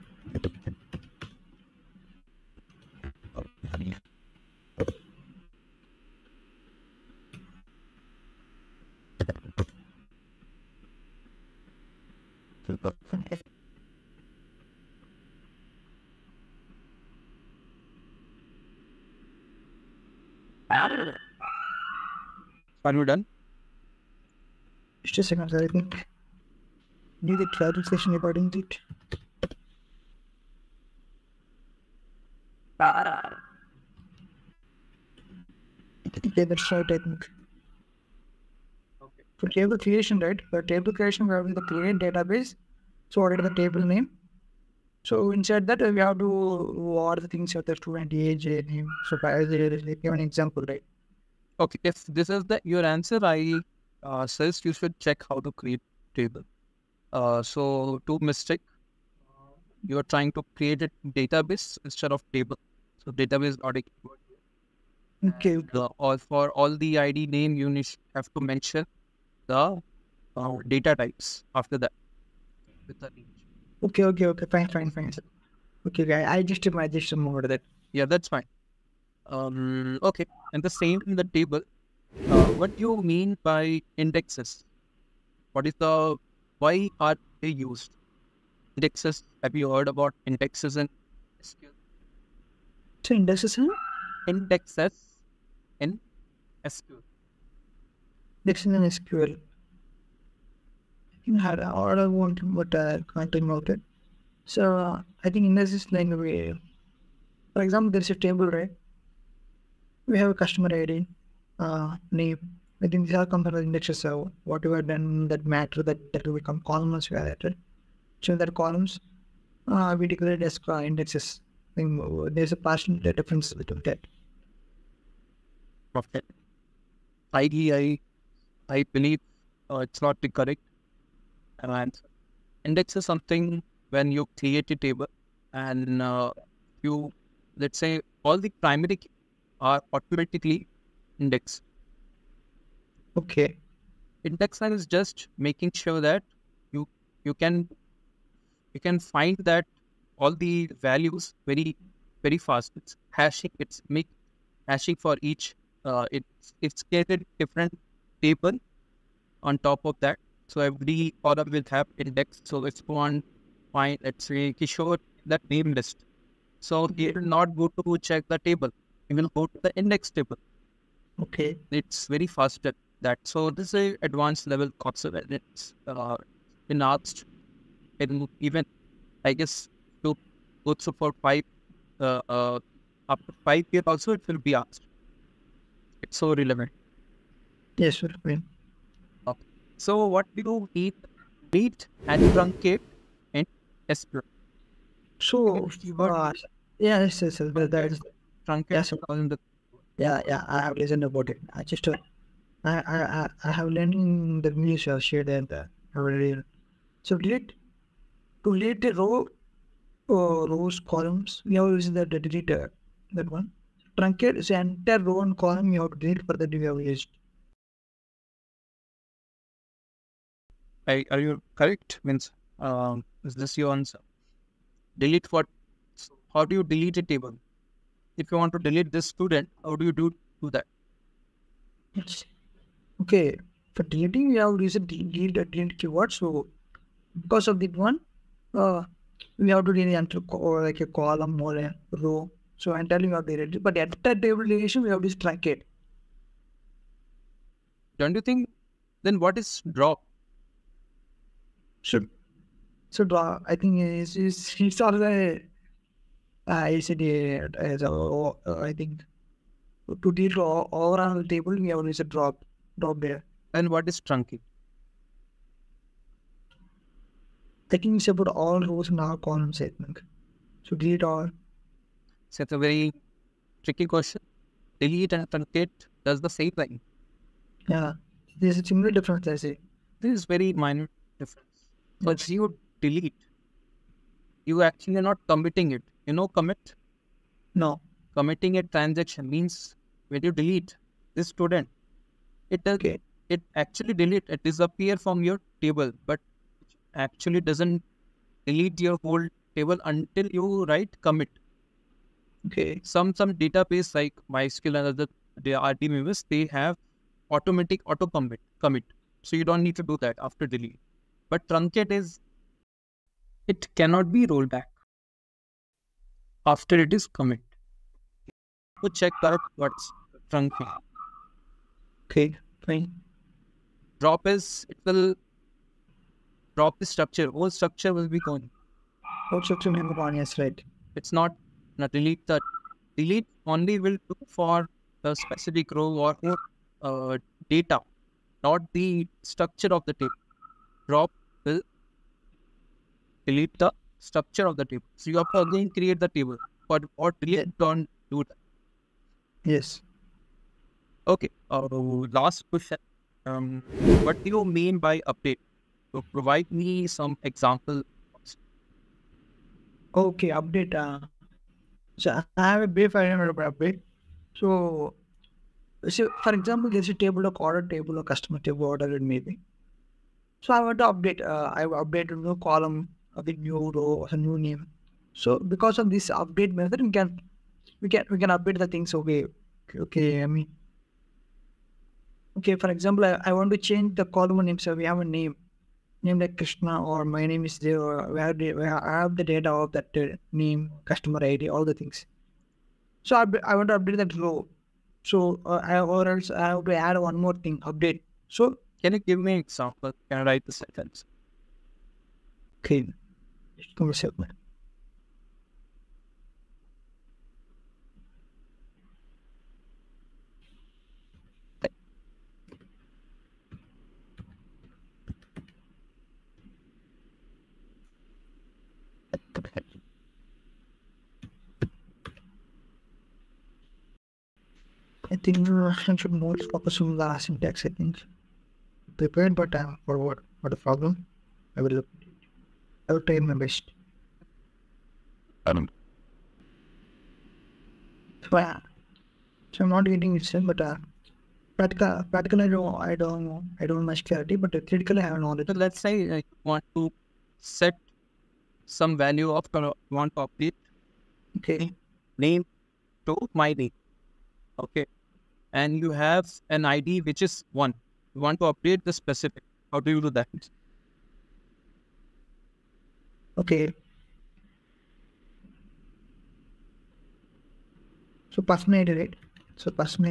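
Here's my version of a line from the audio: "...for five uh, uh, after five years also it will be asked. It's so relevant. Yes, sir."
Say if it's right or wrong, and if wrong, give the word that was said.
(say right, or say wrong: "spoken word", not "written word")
right.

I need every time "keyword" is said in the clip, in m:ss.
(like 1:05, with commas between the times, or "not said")
1:03, 3:55.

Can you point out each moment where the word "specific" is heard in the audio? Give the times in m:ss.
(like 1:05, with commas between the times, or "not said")
5:35, 7:38.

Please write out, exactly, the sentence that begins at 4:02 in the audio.
So entirely we have to delete.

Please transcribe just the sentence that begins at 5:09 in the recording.
So you don't need to do that after delete.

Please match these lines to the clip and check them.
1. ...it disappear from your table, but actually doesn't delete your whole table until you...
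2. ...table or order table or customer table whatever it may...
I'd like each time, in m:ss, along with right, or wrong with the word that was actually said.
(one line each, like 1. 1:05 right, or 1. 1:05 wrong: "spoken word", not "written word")
1. 4:54 right
2. 6:06 right.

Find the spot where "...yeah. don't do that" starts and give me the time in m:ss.
5:47.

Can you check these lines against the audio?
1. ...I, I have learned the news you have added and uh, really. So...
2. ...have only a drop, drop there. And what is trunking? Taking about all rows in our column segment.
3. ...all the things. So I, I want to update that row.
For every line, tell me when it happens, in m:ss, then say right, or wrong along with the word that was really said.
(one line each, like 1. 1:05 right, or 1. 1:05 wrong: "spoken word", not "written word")
1. 3:22 wrong: "shared", not "added"
2. 4:21 right
3. 6:31 right.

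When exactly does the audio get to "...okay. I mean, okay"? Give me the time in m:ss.
6:19.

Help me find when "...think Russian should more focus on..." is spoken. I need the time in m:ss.
7:05.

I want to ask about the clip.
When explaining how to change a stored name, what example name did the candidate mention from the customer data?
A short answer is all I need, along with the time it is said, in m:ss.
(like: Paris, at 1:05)
Krishna, at 6:26.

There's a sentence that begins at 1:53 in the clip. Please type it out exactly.
So whatever then that matter that that will become columns we have added.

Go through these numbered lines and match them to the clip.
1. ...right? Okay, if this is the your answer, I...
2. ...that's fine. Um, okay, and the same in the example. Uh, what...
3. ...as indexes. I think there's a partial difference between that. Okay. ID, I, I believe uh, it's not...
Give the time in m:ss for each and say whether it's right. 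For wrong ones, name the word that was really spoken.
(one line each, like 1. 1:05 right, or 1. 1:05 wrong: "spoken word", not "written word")
1. 0:50 right
2. 1:18 wrong: "table", not "example"
3. 2:00 right.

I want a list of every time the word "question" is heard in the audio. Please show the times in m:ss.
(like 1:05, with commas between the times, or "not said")
4:33, 5:52.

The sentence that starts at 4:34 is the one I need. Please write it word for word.
Delete and truncate does the same thing.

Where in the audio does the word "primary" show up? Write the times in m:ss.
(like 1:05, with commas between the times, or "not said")
2:18.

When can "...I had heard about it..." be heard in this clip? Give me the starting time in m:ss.
1:41.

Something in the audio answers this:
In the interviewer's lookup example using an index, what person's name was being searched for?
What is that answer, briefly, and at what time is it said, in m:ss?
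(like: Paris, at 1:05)
Kishore, at 2:44.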